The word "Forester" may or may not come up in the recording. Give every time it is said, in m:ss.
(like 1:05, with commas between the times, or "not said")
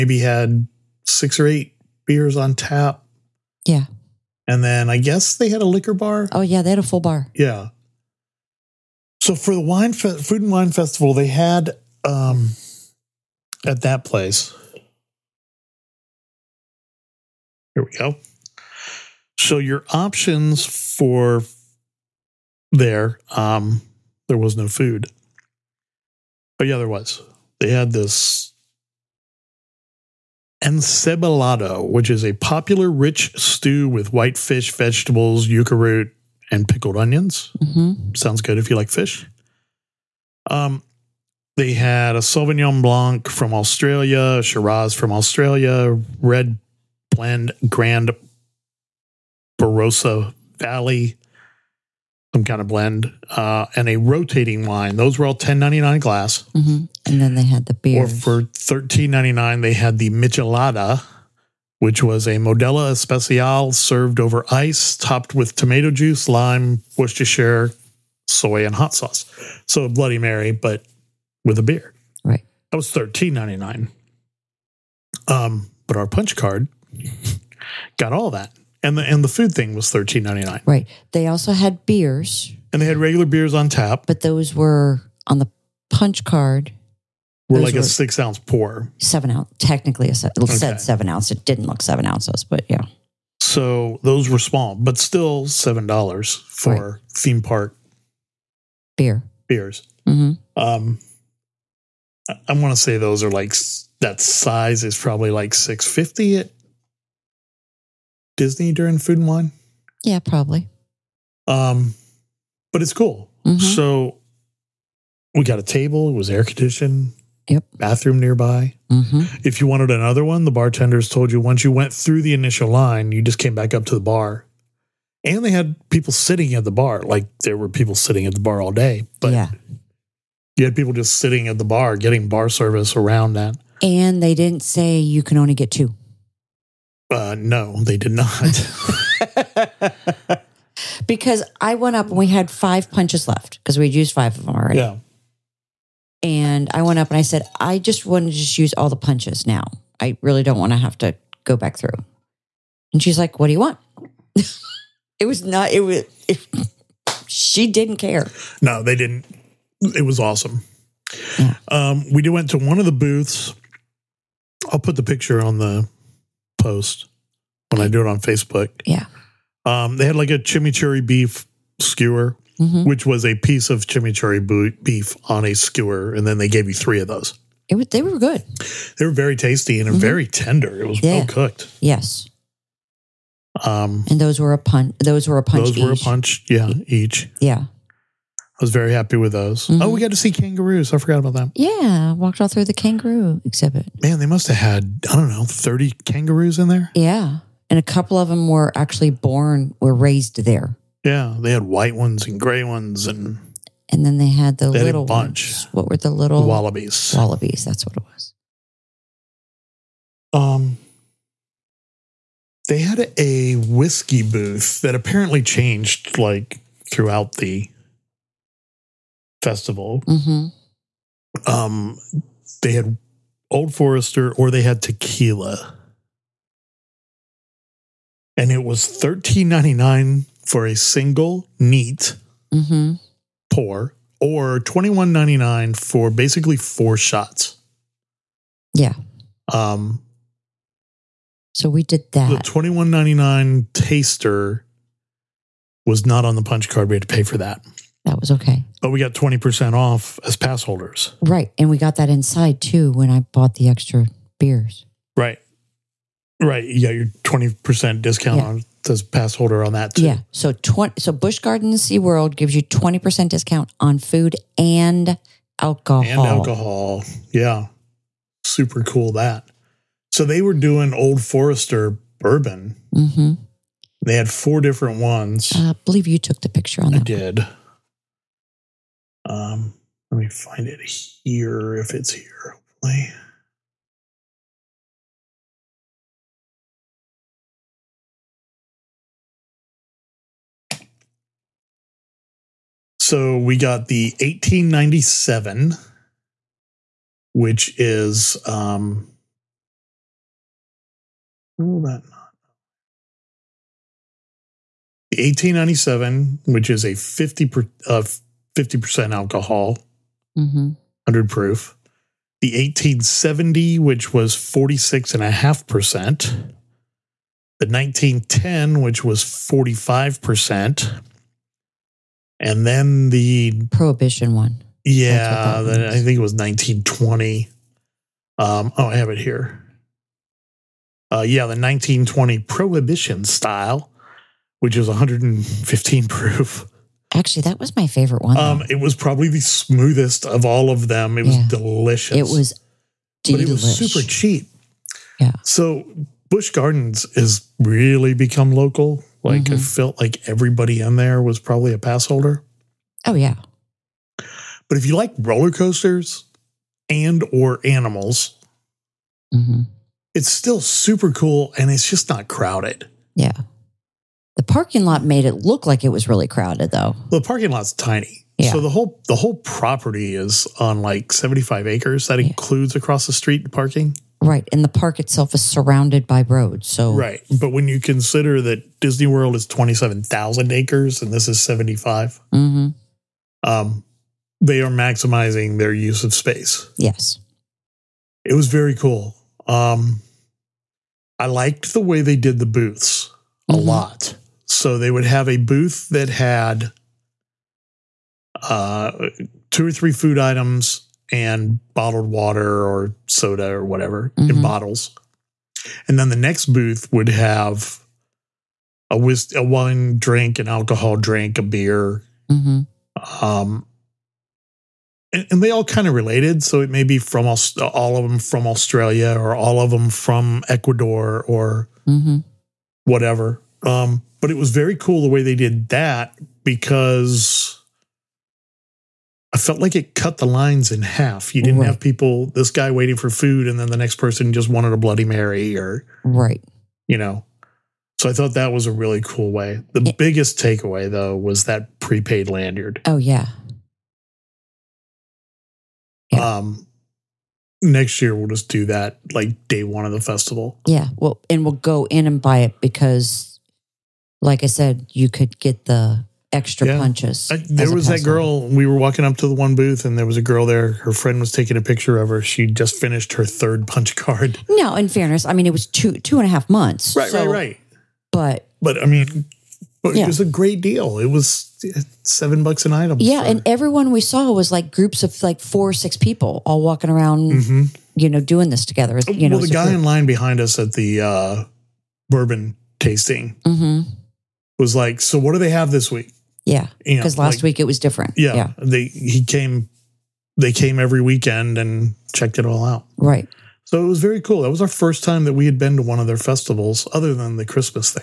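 3:43, 4:31.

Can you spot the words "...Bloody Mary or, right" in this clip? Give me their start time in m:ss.
7:14.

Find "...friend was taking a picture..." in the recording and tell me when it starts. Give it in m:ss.
7:40.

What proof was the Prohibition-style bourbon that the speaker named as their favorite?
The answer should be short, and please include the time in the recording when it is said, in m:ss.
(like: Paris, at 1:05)
115, at 5:34.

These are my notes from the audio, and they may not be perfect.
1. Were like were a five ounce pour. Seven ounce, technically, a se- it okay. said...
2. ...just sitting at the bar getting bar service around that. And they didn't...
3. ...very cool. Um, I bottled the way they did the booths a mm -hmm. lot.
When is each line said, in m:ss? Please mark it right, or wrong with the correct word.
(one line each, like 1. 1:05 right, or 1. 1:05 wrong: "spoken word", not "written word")
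1. 1:27 wrong: "six", not "five"
2. 2:10 right
3. 6:28 wrong: "liked", not "bottled".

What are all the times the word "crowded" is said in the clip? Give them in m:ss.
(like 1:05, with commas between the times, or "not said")
6:02, 6:06.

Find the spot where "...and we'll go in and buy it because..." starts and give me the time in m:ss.
7:31.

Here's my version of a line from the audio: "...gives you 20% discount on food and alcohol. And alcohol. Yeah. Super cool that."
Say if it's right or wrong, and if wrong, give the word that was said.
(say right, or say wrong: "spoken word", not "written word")
right.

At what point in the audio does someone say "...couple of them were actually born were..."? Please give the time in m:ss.
3:17.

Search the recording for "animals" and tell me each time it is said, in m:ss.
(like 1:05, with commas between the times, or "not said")
5:57.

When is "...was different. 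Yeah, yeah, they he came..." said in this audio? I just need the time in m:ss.
8:07.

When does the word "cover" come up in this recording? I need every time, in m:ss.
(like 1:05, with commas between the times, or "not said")
not said.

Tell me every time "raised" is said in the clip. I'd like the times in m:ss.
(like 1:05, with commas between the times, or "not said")
3:19.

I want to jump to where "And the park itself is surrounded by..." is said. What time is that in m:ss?
6:14.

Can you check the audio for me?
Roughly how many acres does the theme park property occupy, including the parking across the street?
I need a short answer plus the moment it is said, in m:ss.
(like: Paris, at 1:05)
75, at 6:11.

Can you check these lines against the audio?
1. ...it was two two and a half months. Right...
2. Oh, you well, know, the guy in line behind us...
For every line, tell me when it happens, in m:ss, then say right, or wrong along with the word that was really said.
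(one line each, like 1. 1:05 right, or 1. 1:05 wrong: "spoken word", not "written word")
1. 7:45 right
2. 7:58 right.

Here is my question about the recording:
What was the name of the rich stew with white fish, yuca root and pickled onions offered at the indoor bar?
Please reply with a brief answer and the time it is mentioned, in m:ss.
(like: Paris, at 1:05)
Encebolado, at 0:30.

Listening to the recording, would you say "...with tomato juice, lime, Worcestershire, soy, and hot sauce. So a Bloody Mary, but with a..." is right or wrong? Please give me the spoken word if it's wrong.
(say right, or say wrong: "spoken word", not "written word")
right.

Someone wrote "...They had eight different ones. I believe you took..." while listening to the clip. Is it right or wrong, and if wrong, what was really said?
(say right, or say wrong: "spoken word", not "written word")
wrong: "four", not "eight".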